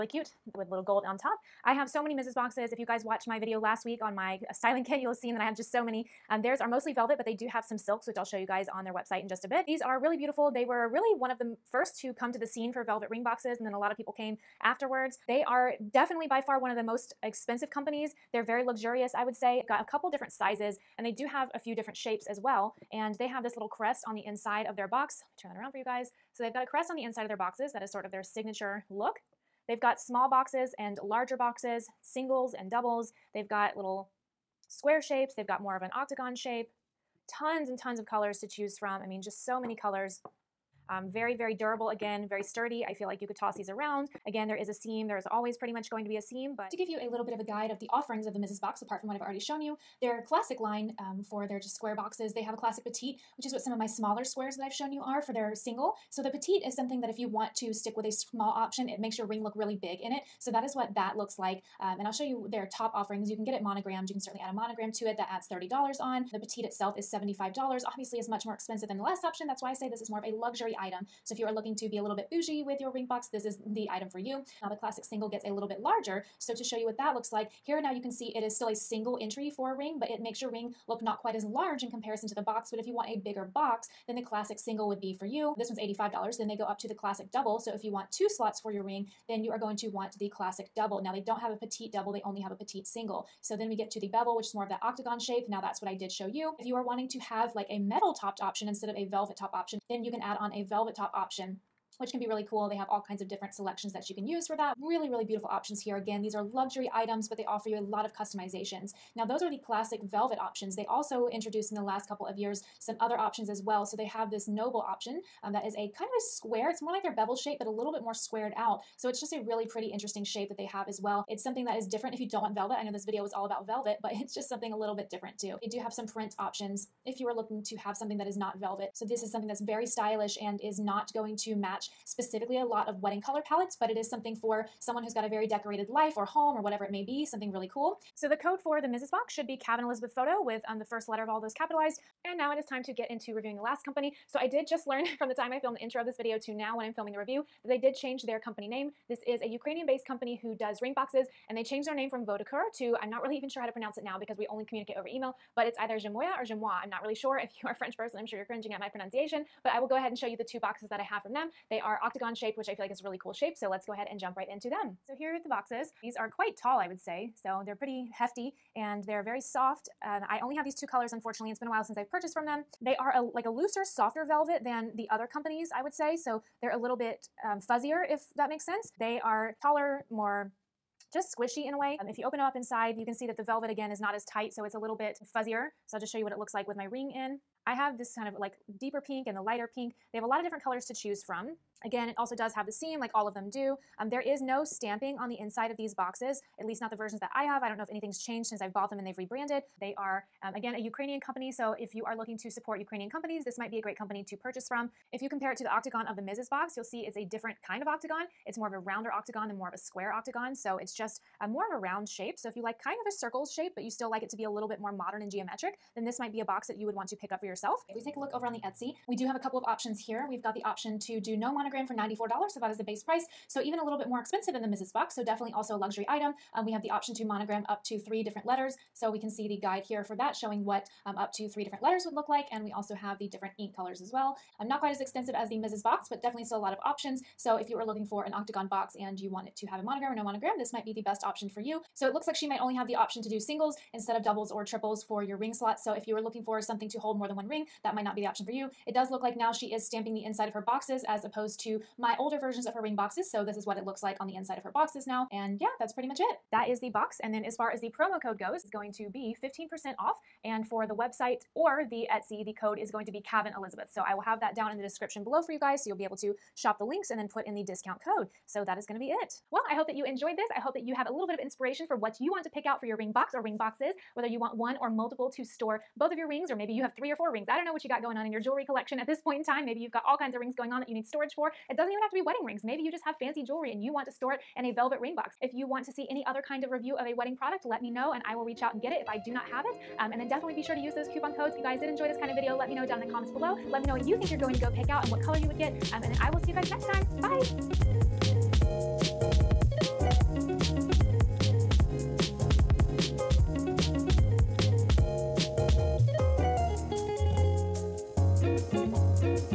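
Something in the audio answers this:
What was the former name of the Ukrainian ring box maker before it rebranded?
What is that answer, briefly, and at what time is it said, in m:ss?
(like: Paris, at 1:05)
Vodacure, at 2:32.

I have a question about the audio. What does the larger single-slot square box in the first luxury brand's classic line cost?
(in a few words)
$85.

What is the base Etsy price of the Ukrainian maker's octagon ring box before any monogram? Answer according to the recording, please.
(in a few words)
$94.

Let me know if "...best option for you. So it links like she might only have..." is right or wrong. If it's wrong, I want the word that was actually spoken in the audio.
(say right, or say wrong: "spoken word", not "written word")
wrong: "looks", not "links".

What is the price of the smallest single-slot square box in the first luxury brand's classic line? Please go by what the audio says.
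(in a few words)
$75.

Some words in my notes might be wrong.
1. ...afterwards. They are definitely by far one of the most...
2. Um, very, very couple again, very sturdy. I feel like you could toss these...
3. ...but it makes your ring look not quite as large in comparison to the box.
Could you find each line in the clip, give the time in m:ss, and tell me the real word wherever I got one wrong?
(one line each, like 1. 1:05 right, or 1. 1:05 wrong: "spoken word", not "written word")
1. 0:14 right
2. 0:40 wrong: "durable", not "couple"
3. 1:19 right.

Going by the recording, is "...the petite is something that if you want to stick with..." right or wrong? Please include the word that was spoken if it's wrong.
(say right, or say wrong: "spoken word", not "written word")
right.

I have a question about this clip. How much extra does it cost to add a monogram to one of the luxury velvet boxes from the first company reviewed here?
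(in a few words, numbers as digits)
$30.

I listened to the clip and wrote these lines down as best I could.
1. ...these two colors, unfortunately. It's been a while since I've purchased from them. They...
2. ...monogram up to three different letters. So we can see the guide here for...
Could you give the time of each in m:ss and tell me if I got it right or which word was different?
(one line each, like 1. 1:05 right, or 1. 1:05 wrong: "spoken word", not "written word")
1. 2:50 right
2. 3:47 right.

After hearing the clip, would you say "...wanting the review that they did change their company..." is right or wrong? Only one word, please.
wrong.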